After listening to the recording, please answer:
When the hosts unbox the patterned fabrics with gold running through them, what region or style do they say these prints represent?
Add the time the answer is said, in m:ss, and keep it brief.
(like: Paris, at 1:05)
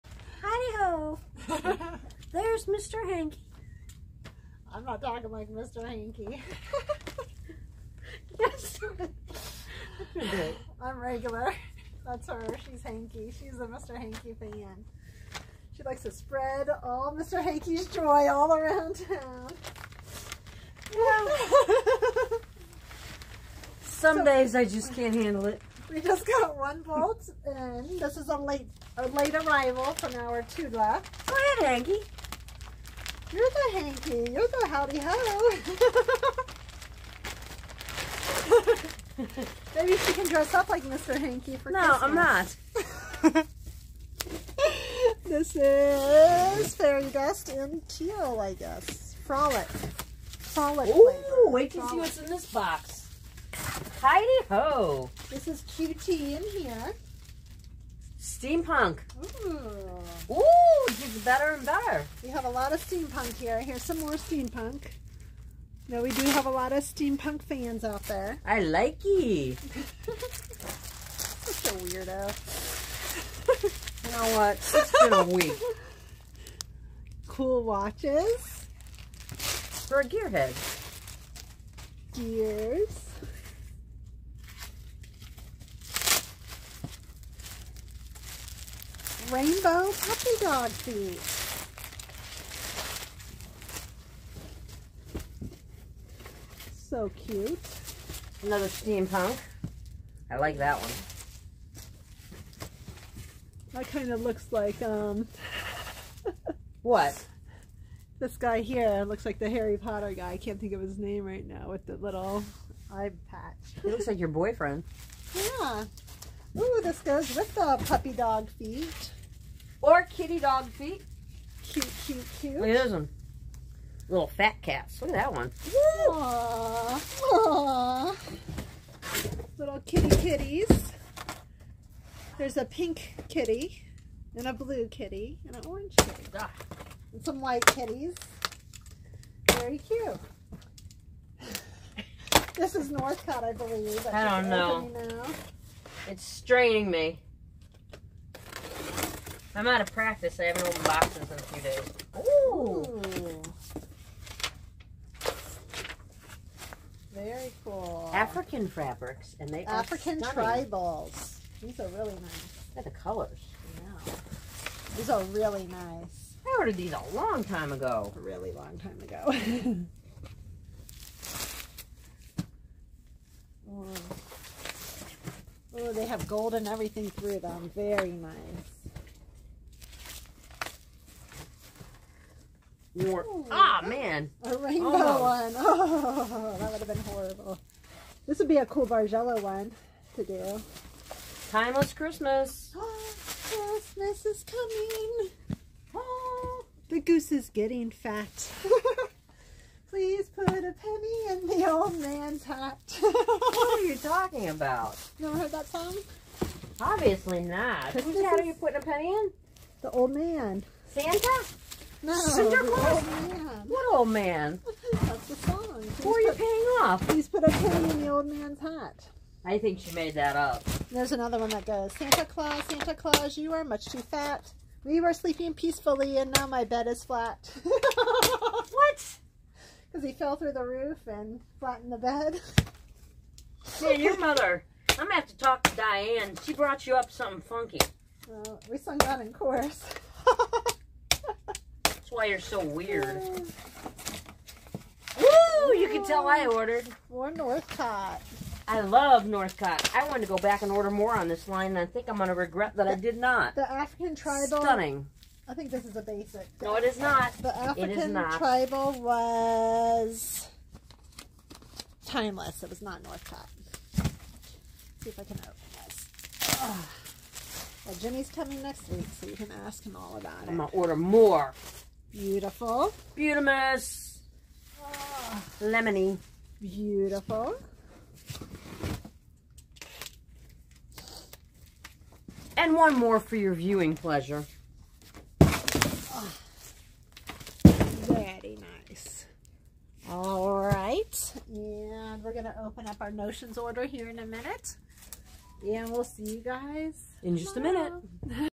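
African tribal, at 2:38.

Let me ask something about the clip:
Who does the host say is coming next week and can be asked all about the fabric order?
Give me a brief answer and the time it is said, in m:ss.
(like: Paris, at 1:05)
Jimmy, at 4:28.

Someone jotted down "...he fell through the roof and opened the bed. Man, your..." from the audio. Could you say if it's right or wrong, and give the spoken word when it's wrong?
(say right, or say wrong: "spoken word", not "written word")
wrong: "flattened", not "opened".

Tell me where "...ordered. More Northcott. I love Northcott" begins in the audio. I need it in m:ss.
4:06.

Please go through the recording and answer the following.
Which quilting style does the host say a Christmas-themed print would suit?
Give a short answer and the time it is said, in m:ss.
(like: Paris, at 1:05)
Bargello, at 3:08.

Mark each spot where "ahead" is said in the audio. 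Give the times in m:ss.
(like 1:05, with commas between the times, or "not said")
0:31.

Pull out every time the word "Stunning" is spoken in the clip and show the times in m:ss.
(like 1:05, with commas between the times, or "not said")
4:14.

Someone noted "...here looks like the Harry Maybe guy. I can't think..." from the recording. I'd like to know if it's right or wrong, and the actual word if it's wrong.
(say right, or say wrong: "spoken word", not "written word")
wrong: "Potter", not "Maybe".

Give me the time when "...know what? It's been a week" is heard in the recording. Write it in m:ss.
1:14.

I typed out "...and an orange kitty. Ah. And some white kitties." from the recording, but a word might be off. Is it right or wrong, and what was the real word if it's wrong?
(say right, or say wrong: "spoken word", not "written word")
right.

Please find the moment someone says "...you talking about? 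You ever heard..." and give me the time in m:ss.
3:23.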